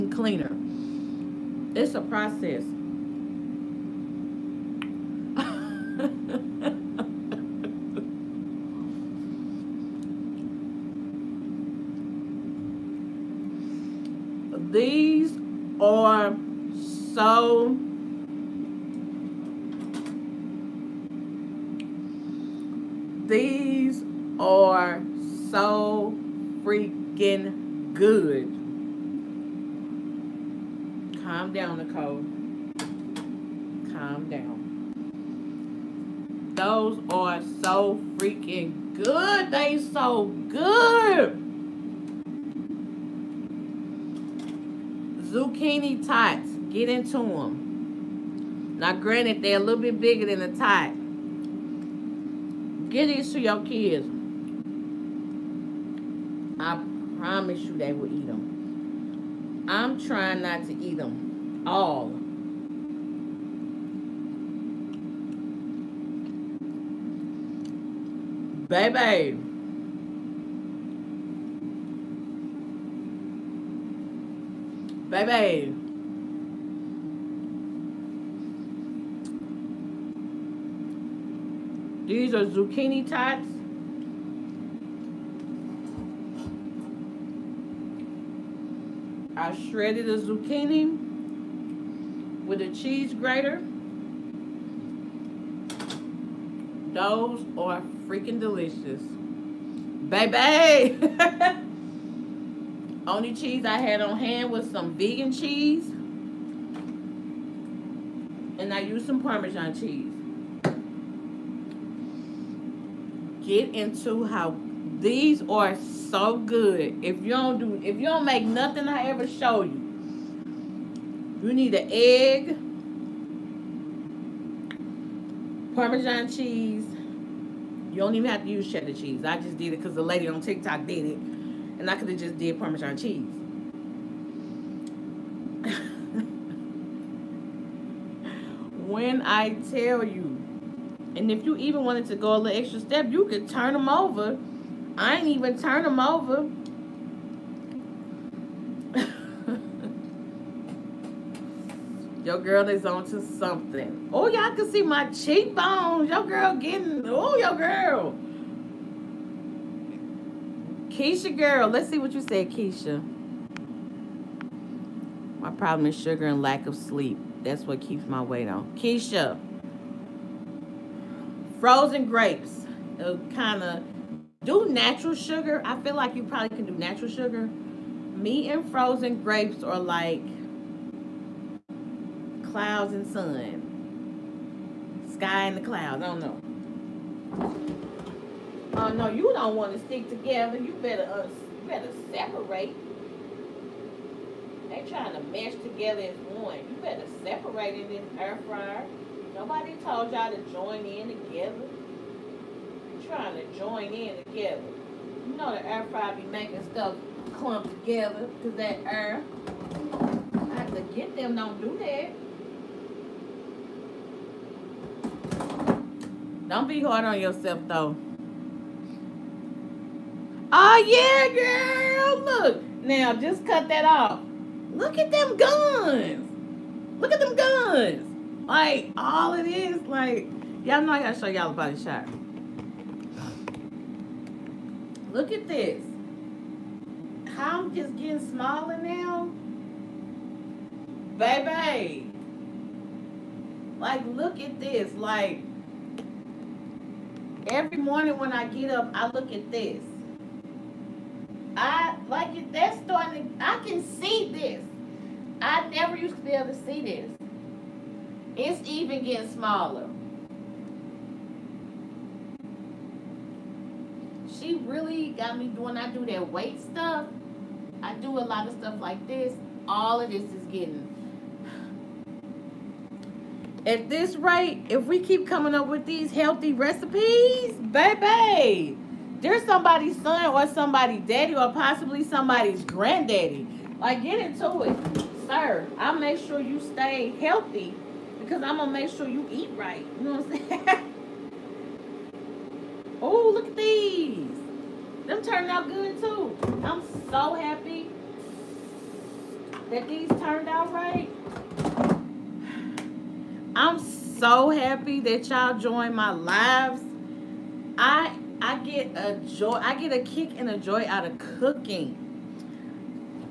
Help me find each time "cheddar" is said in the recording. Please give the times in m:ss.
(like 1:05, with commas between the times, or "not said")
2:08.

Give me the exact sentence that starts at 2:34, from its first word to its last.
Oh, y'all can see my cheekbones.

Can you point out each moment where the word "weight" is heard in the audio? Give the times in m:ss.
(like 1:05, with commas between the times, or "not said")
2:48, 4:26.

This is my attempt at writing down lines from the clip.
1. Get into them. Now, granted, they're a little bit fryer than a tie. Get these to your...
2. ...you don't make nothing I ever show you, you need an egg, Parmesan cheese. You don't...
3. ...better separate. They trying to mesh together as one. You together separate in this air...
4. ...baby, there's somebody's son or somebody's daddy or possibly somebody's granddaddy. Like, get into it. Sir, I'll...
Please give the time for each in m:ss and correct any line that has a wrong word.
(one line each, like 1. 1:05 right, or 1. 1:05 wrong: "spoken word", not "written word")
1. 0:46 wrong: "bigger", not "fryer"
2. 1:57 right
3. 3:11 wrong: "better", not "together"
4. 4:37 right.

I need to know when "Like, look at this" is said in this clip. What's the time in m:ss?
4:03.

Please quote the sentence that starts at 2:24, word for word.
I ain't even turn them over.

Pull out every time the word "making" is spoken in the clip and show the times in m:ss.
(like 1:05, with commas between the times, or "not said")
3:26.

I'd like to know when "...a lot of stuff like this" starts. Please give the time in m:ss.
4:28.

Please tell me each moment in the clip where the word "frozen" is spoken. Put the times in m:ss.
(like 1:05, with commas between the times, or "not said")
2:51, 2:58.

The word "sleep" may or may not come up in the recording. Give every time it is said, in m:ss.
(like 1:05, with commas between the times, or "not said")
2:46.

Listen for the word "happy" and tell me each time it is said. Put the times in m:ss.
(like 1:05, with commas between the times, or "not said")
4:57, 5:04.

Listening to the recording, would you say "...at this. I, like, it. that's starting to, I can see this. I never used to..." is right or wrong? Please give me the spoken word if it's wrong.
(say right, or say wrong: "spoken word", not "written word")
right.